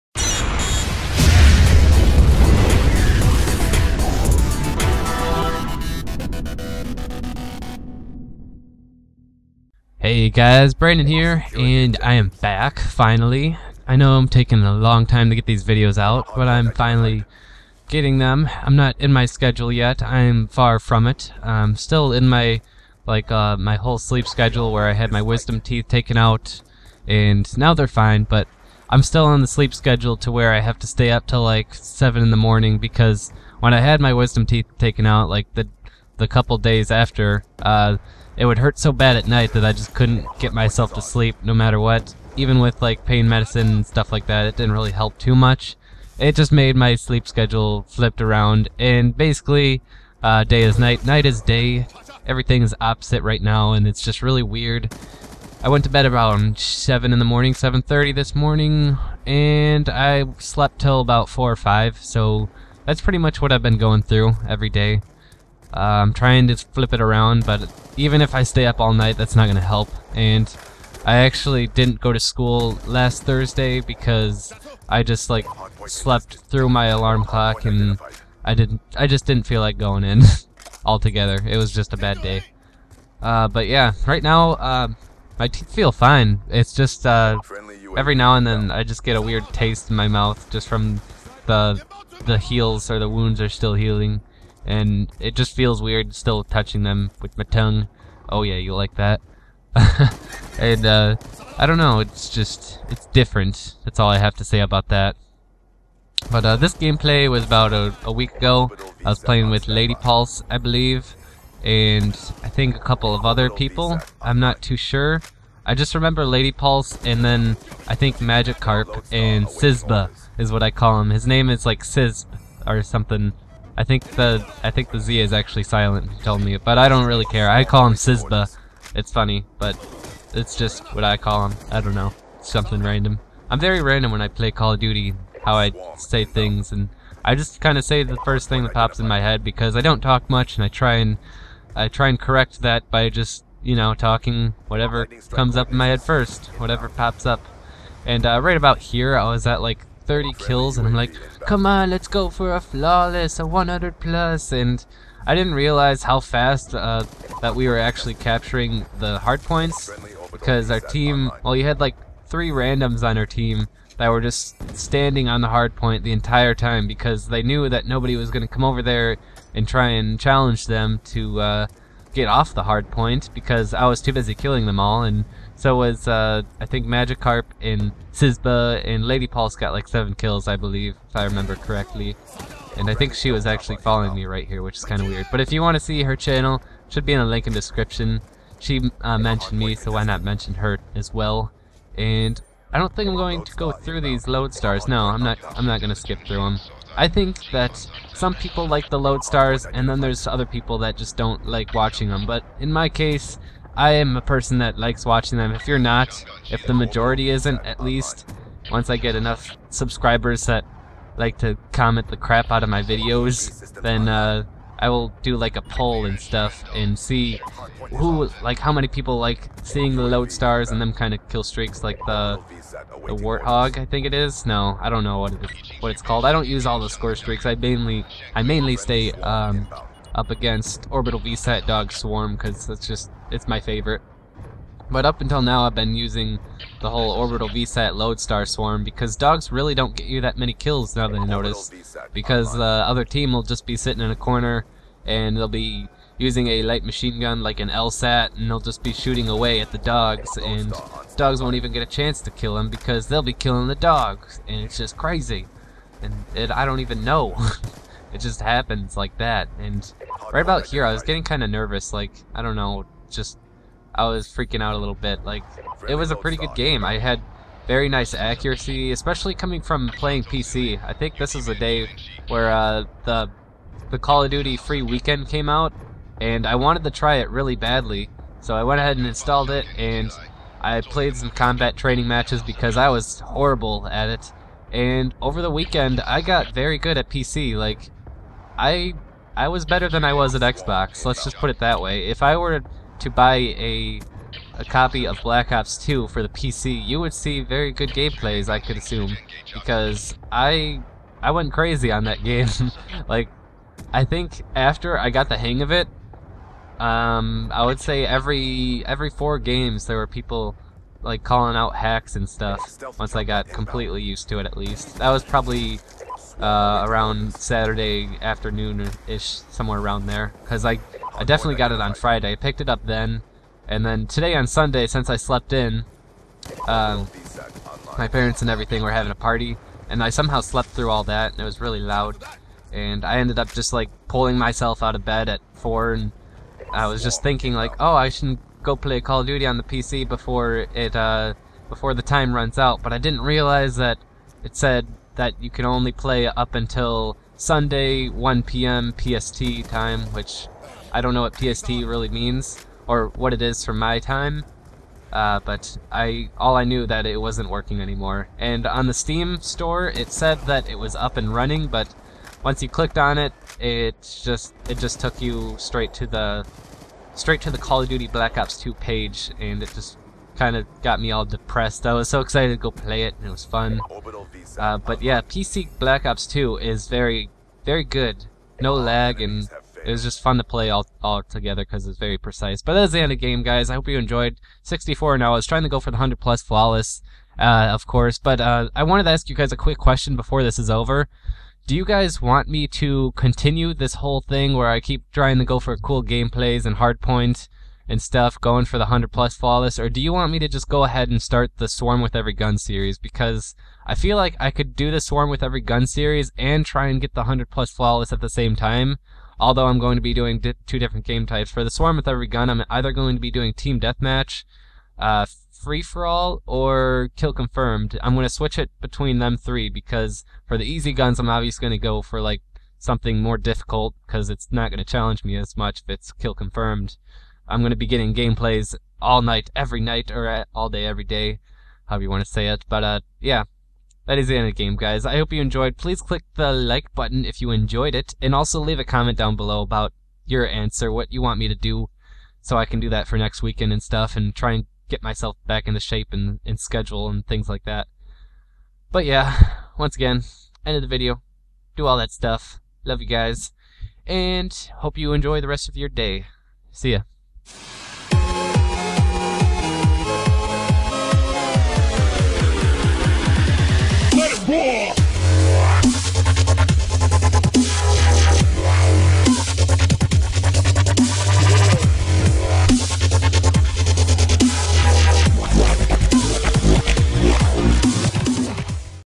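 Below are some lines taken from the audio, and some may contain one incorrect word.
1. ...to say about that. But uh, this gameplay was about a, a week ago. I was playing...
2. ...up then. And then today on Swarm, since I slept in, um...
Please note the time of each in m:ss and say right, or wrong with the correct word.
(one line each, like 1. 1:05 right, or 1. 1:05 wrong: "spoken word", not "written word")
1. 1:44 right
2. 5:22 wrong: "Sunday", not "Swarm".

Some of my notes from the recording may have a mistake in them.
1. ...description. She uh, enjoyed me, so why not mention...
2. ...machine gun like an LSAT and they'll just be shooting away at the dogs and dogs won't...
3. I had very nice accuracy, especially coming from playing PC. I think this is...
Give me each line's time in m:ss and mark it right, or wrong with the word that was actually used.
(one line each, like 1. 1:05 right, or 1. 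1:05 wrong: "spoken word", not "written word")
1. 3:07 wrong: "mentioned", not "enjoyed"
2. 4:06 right
3. 4:26 right.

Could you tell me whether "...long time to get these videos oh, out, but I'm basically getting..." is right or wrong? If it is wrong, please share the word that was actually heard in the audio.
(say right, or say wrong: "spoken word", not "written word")
wrong: "finally", not "basically".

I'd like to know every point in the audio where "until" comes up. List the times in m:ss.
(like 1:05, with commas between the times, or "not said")
3:55, 5:46.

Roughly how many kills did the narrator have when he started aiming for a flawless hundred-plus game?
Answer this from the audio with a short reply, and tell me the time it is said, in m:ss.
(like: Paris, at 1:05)
30, at 2:30.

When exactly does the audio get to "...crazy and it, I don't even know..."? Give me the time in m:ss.
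4:14.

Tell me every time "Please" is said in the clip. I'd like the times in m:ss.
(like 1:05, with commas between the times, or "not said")
7:15.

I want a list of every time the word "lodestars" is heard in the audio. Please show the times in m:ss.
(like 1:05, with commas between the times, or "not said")
3:14, 3:18, 3:40, 3:57.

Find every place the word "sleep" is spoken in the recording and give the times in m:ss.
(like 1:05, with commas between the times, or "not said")
0:23, 0:29, 0:41, 0:46.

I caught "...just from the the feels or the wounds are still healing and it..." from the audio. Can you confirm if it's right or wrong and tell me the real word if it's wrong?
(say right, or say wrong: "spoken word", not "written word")
wrong: "heals", not "feels".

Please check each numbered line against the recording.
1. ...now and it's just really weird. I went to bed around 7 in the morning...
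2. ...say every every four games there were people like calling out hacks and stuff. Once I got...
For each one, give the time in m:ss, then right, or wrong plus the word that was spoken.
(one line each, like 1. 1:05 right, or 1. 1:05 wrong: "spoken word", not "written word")
1. 0:53 right
2. 5:07 right.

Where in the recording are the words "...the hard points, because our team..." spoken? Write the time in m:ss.
2:38.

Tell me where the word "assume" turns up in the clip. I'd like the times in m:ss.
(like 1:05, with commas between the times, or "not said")
4:58.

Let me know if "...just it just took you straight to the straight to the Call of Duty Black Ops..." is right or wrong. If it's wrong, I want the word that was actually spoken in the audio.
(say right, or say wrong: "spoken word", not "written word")
right.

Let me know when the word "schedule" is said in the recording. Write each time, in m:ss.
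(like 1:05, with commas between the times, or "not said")
0:19, 0:24, 0:29, 0:47, 7:26.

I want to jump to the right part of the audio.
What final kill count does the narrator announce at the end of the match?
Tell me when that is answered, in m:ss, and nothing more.
6:24.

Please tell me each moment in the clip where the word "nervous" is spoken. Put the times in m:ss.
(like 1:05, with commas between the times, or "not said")
4:21.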